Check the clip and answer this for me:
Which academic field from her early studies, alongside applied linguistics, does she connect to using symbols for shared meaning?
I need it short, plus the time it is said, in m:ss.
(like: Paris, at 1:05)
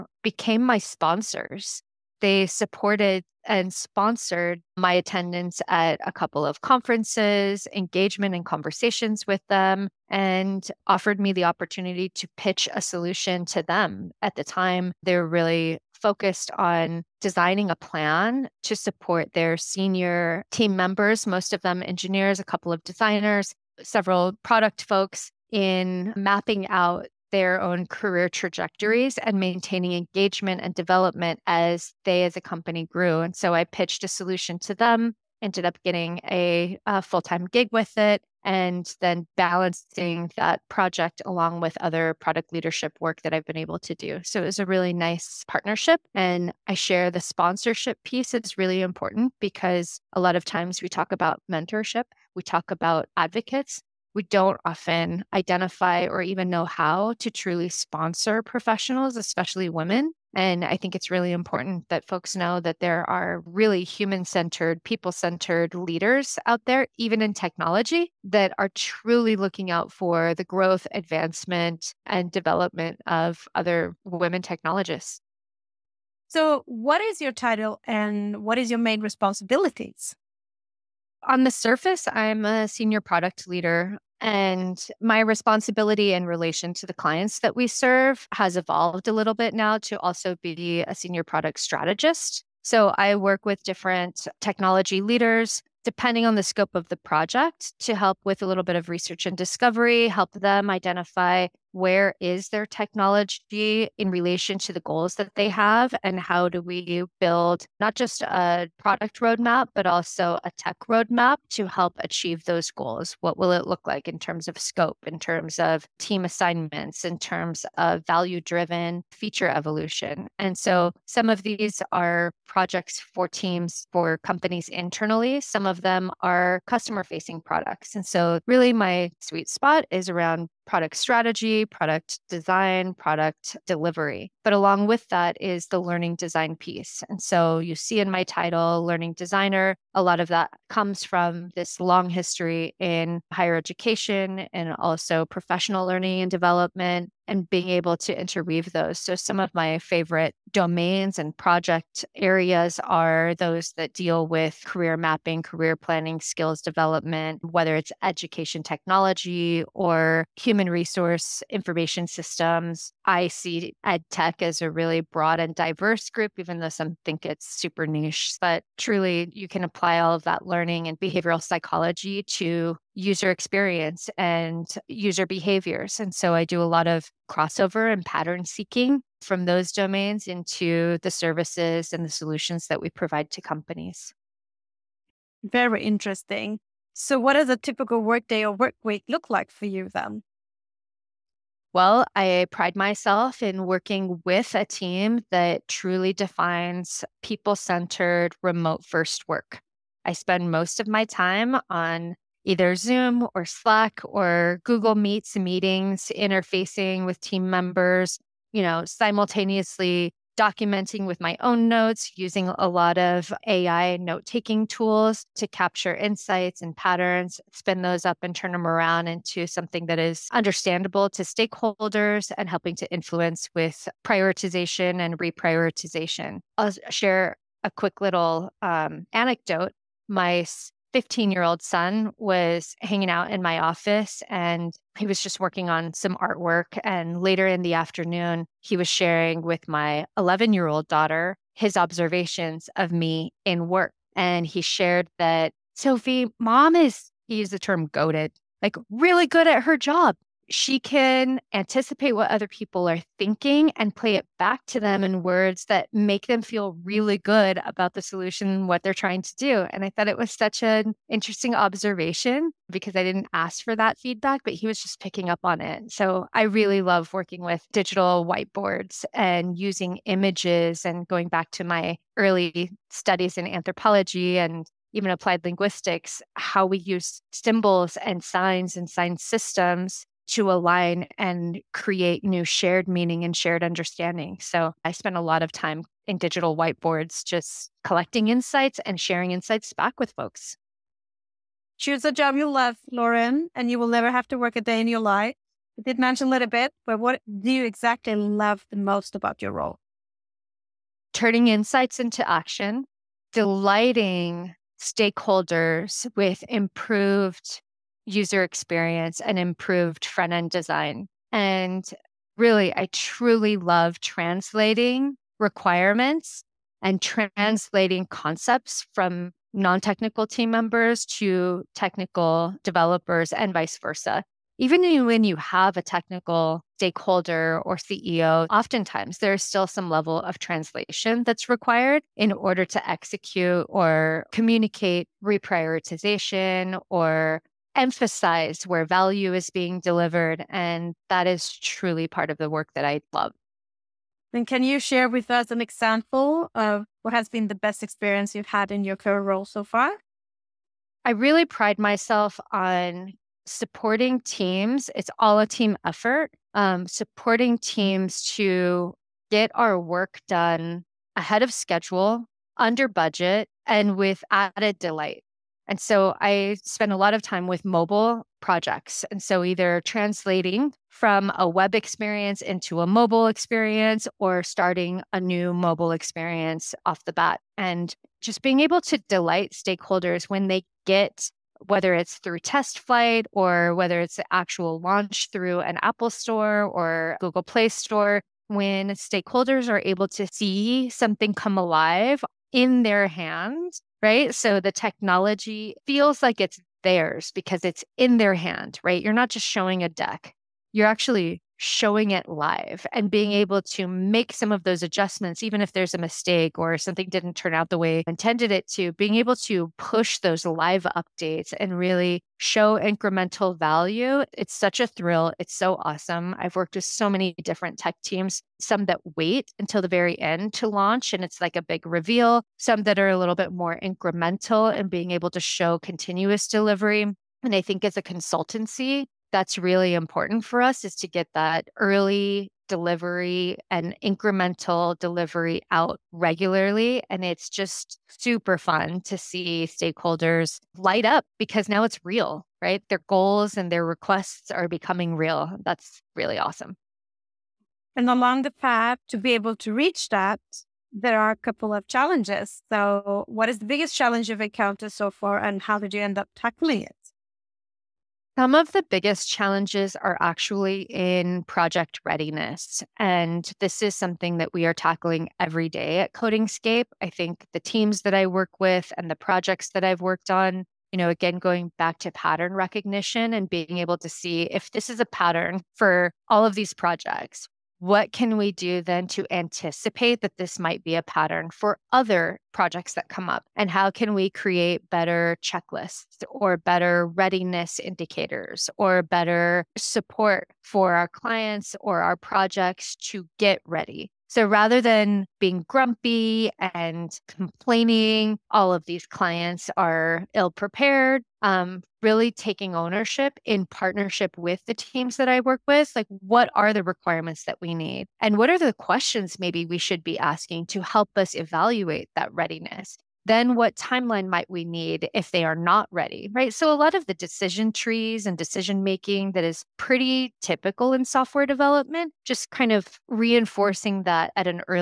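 anthropology, at 4:33.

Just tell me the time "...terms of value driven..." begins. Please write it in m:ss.
1:57.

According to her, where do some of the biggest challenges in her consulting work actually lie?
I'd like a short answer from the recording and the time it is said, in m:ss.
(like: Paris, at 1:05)
project readiness, at 7:41.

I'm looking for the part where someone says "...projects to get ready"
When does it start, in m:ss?
8:12.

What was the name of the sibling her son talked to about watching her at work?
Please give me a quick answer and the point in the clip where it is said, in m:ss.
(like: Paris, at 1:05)
Sophie, at 4:05.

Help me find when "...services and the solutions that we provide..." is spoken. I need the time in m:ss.
3:01.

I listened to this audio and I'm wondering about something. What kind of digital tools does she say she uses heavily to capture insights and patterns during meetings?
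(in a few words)
AI note taking tools.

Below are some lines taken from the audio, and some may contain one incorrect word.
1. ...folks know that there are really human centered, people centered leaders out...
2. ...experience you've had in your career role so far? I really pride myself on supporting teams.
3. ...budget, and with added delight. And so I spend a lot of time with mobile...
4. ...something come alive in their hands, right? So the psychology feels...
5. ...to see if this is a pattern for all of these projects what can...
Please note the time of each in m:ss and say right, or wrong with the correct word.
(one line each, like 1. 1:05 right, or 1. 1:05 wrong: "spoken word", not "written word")
1. 1:02 right
2. 5:47 right
3. 6:02 right
4. 6:30 wrong: "technology", not "psychology"
5. 7:53 right.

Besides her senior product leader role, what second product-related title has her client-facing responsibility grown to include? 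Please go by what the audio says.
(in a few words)
senior product strategist.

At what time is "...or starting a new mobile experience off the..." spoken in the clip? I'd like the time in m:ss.
6:14.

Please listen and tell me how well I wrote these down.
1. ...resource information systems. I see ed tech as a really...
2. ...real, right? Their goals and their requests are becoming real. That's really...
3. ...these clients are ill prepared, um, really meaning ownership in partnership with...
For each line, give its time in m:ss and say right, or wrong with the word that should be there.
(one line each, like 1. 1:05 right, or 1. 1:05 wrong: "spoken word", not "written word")
1. 2:40 right
2. 7:22 right
3. 8:18 wrong: "taking", not "meaning".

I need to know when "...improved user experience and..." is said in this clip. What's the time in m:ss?
5:06.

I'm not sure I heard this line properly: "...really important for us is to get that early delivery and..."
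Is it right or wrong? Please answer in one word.
right.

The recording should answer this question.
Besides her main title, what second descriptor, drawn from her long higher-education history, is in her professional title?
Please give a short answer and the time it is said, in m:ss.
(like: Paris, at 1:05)
learning designer, at 2:18.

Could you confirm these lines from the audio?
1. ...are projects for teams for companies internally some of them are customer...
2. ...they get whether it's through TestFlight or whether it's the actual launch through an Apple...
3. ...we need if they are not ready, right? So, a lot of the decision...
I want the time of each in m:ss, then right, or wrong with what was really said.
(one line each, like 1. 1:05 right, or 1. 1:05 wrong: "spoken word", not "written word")
1. 2:01 right
2. 6:20 right
3. 8:34 right.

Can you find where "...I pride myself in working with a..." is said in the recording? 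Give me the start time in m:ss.
3:12.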